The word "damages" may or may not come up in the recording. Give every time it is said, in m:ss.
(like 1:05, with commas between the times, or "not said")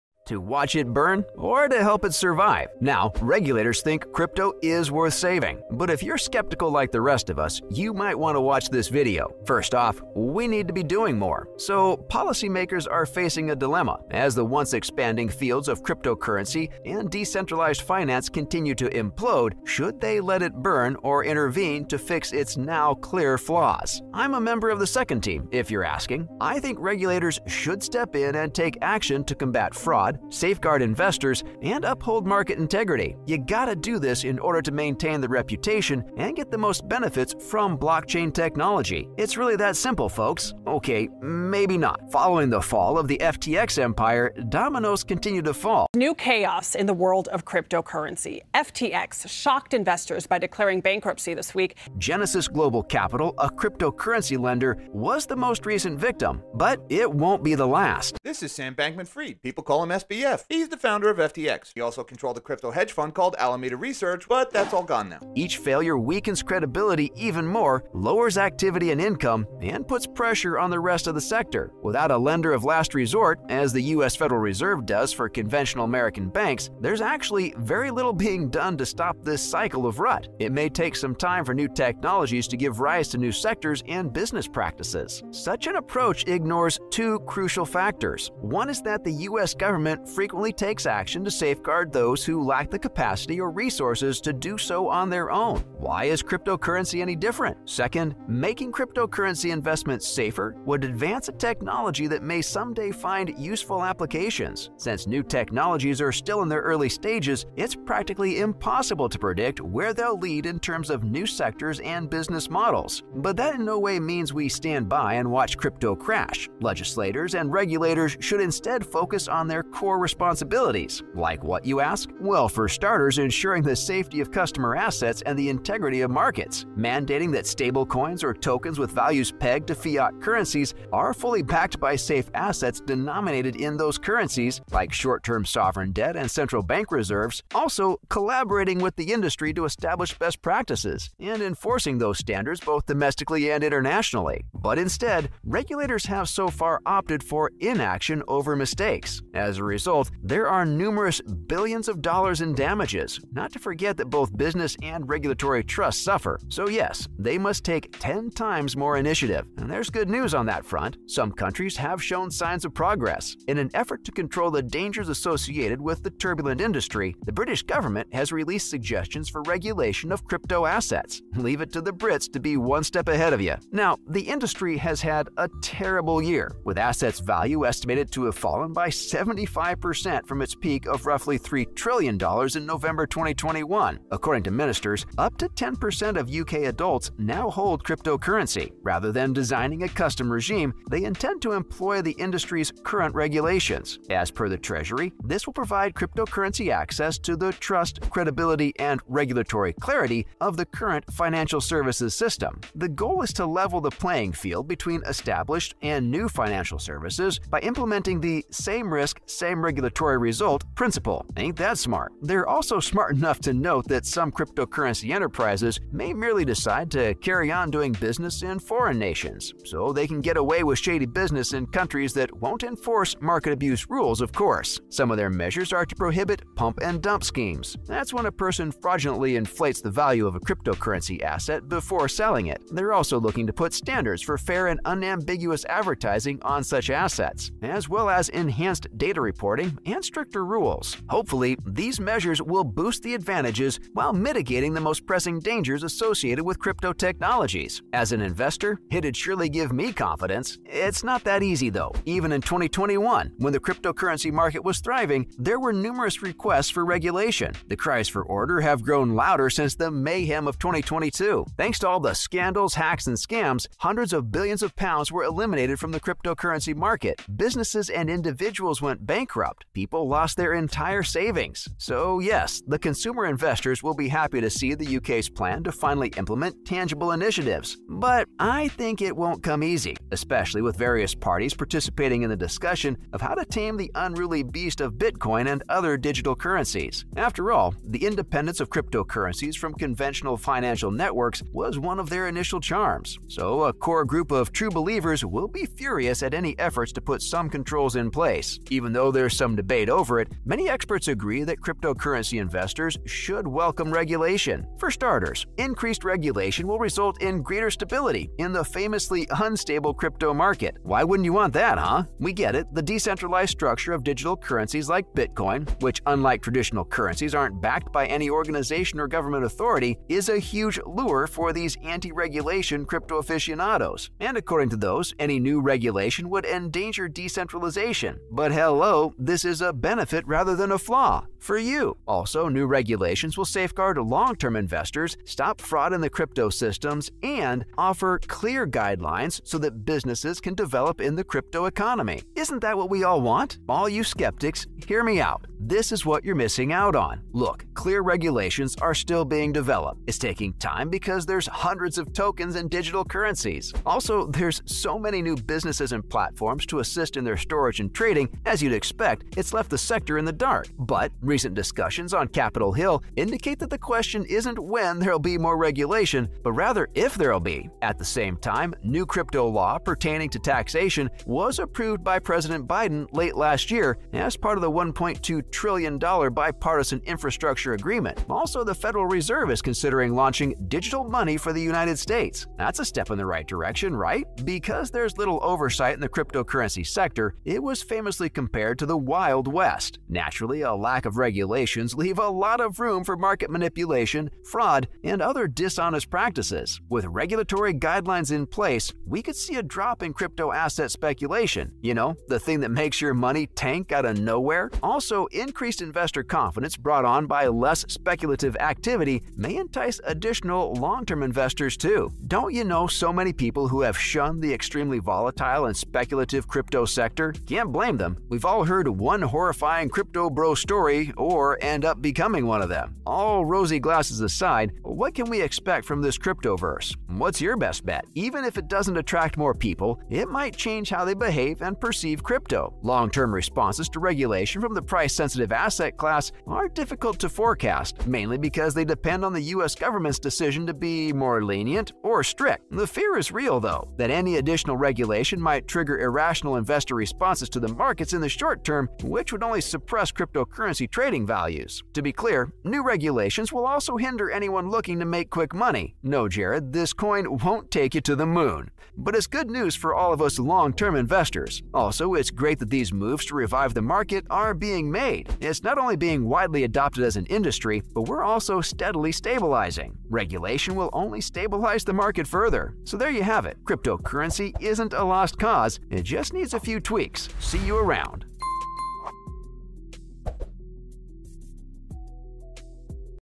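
2:32.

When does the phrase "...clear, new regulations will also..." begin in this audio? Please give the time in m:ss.
7:32.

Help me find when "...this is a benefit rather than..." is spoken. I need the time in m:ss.
5:29.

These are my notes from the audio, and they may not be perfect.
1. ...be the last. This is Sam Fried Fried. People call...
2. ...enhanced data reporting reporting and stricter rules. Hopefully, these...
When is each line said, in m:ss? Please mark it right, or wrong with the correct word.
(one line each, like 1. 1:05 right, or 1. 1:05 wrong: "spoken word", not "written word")
1. 0:57 wrong: "Bankman", not "Fried"
2. 3:58 right.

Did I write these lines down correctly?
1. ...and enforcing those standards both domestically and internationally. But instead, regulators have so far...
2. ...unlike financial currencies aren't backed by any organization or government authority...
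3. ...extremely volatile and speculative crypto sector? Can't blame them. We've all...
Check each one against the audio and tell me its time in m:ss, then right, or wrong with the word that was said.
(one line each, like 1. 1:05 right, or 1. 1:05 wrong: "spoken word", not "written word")
1. 2:21 right
2. 5:16 wrong: "traditional", not "financial"
3. 6:54 right.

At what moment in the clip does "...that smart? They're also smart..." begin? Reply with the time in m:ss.
3:31.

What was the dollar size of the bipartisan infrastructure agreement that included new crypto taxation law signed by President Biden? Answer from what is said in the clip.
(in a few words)
$1.2 trillion.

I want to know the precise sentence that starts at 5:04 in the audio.
For starters, increased regulation will result in greater stability in the famously unstable crypto market.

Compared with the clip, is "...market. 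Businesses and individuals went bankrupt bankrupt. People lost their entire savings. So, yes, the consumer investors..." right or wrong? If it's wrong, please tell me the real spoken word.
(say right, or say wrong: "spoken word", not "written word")
right.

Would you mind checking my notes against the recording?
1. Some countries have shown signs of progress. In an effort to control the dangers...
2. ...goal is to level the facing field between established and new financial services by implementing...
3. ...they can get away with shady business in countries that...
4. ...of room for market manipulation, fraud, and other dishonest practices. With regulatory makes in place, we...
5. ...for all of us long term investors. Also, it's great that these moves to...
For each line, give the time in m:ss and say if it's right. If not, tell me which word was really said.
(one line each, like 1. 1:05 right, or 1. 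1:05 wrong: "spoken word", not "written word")
1. 2:41 right
2. 3:22 wrong: "playing", not "facing"
3. 3:39 right
4. 6:32 wrong: "guidelines", not "makes"
5. 7:39 right.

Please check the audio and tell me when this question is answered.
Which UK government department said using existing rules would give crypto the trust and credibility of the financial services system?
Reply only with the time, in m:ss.
3:14.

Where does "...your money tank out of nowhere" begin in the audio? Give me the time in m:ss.
6:42.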